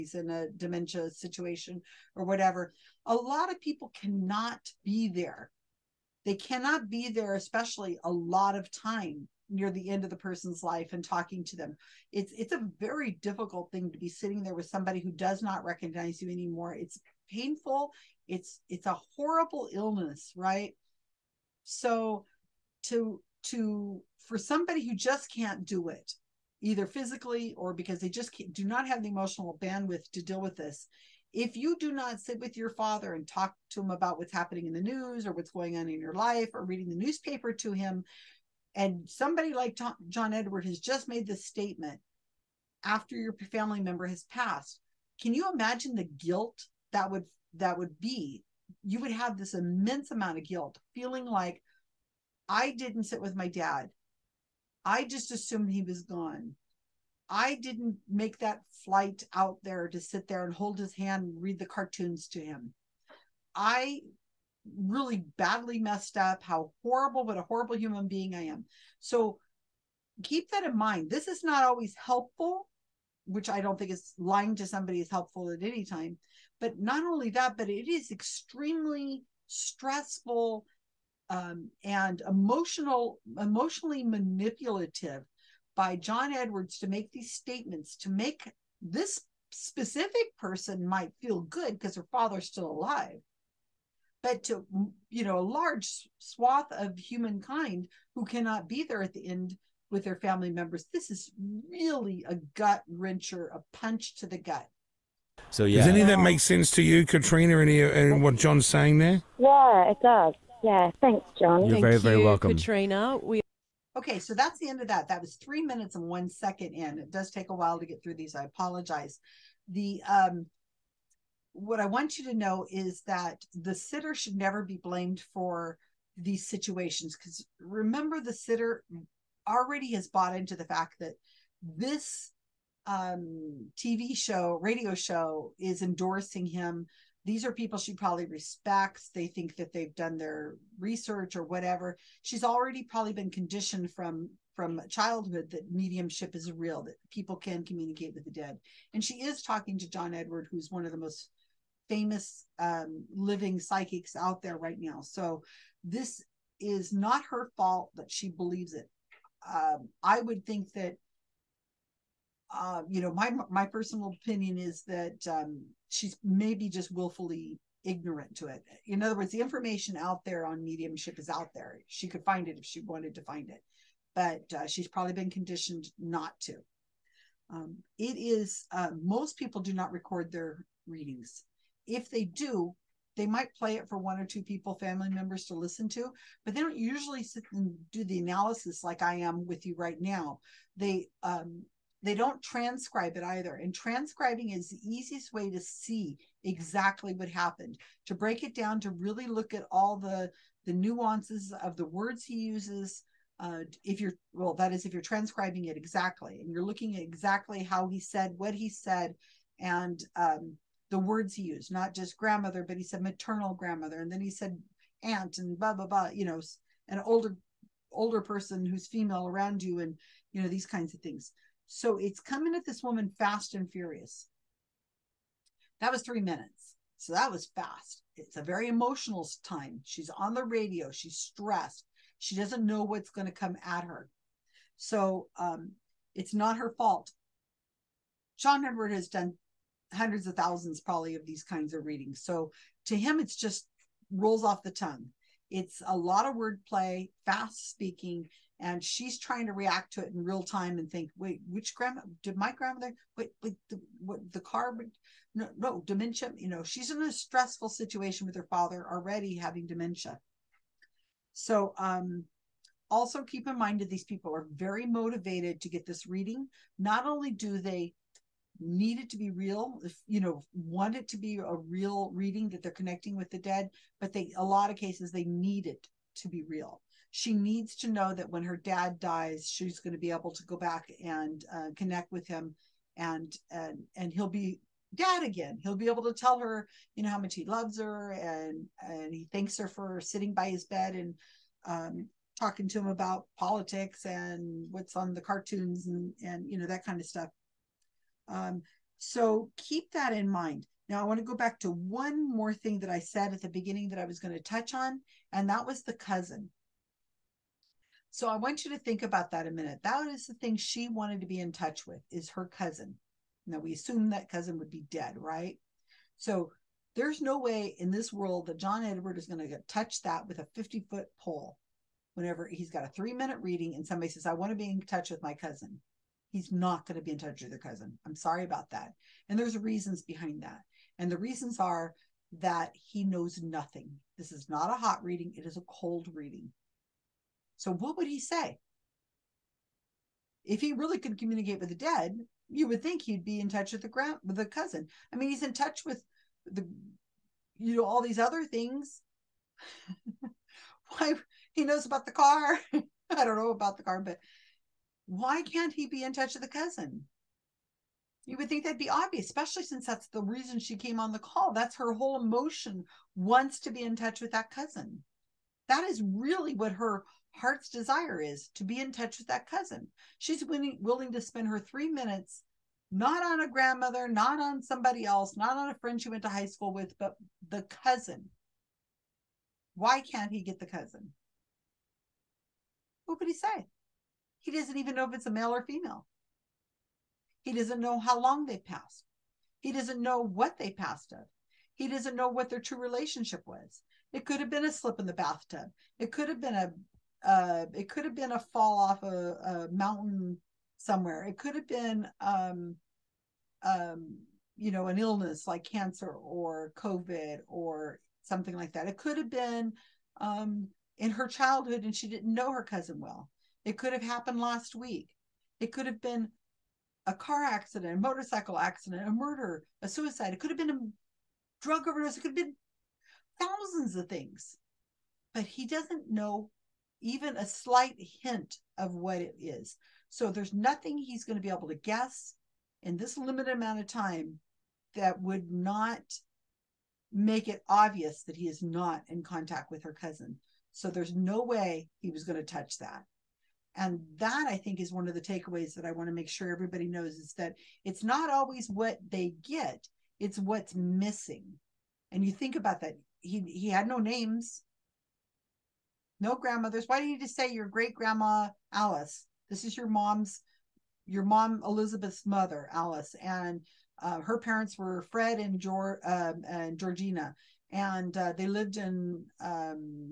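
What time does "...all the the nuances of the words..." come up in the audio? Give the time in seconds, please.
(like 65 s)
199 s.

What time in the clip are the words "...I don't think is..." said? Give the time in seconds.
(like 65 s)
73 s.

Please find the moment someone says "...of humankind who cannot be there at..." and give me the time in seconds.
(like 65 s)
96 s.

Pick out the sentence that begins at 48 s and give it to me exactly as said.
You would have this immense amount of guilt, feeling like I didn't sit with my dad.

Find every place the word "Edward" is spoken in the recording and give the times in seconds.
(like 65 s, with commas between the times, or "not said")
40 s, 86 s, 150 s, 238 s, 318 s.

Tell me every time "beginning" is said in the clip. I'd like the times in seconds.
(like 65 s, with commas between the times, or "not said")
303 s.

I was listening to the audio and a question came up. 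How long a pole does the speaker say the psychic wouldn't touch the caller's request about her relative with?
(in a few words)
50 foot.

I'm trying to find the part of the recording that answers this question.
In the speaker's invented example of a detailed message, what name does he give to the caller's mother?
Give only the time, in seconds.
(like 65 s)
461 s.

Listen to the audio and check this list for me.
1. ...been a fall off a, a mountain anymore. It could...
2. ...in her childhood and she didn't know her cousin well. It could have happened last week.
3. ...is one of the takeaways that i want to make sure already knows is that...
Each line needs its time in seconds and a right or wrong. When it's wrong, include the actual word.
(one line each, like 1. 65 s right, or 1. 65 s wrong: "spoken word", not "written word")
1. 398 s wrong: "somewhere", not "anymore"
2. 410 s right
3. 444 s wrong: "everybody", not "already".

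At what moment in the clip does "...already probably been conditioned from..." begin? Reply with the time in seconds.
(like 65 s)
142 s.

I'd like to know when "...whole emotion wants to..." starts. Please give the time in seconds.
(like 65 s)
361 s.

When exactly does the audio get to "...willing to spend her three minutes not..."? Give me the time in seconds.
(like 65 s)
370 s.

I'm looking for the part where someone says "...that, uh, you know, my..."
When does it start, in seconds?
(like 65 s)
160 s.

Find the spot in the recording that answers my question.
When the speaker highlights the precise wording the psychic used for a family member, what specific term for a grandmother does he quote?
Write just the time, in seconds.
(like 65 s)
213 s.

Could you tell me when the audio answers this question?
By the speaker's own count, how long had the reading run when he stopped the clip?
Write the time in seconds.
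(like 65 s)
115 s.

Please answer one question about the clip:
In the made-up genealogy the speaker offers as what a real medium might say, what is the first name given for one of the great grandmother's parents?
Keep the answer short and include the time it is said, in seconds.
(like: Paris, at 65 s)
Fred, at 465 s.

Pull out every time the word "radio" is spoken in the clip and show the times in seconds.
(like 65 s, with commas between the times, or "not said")
134 s, 230 s.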